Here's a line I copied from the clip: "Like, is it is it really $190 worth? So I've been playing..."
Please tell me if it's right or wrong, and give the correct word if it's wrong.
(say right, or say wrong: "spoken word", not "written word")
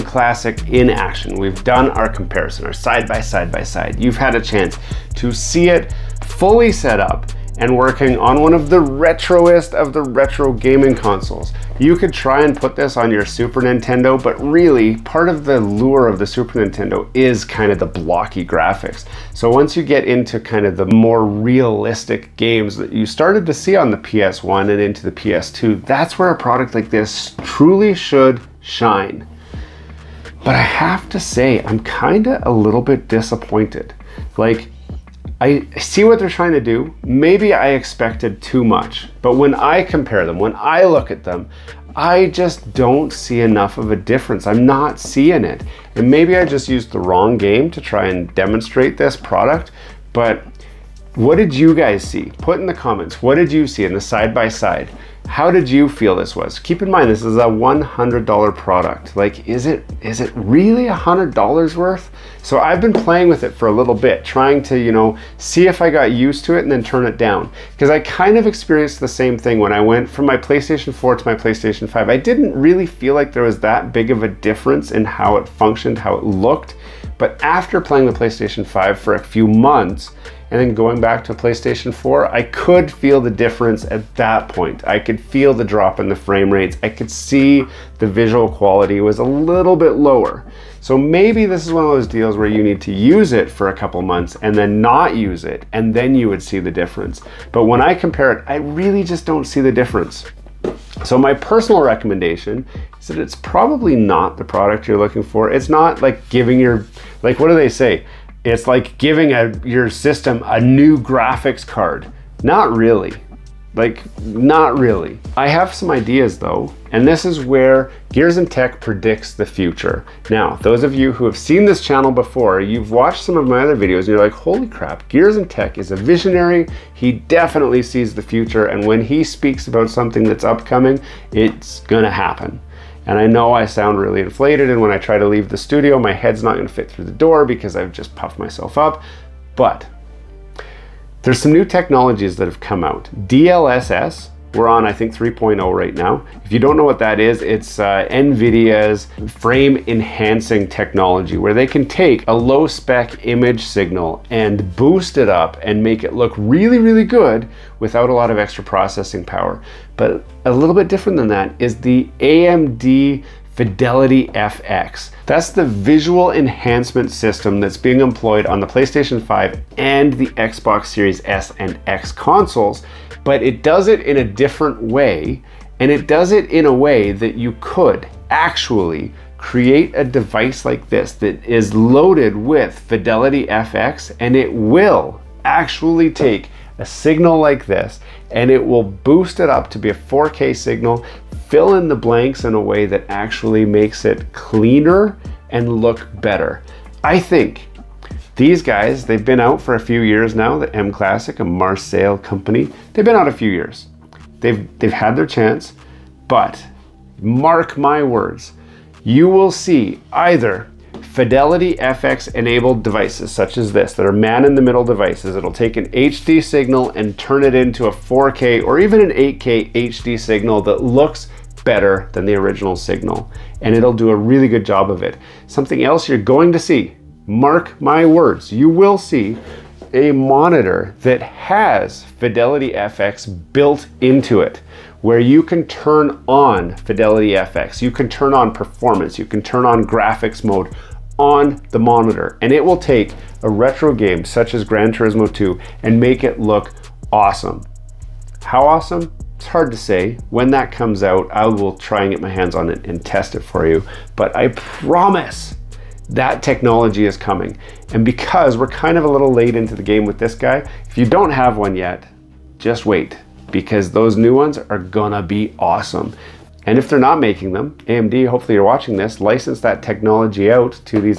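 wrong: "100", not "190".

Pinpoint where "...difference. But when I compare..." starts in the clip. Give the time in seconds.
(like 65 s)
96 s.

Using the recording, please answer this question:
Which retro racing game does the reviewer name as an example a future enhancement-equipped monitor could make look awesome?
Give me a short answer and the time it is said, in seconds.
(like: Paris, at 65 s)
Gran Turismo 2, at 244 s.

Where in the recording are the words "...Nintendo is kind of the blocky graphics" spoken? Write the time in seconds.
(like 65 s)
16 s.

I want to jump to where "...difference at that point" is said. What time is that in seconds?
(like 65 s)
83 s.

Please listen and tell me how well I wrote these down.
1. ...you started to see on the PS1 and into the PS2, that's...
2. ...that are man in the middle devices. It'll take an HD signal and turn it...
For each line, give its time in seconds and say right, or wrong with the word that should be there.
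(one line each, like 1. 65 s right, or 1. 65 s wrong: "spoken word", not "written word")
1. 22 s right
2. 213 s right.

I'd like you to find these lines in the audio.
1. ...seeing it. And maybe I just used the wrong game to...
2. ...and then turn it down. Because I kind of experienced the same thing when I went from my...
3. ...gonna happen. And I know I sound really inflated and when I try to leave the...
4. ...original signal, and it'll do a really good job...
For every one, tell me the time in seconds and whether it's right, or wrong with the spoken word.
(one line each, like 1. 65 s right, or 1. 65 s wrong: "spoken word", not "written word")
1. 44 s right
2. 66 s right
3. 131 s right
4. 222 s right.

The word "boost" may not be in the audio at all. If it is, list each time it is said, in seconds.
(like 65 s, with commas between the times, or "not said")
154 s, 188 s.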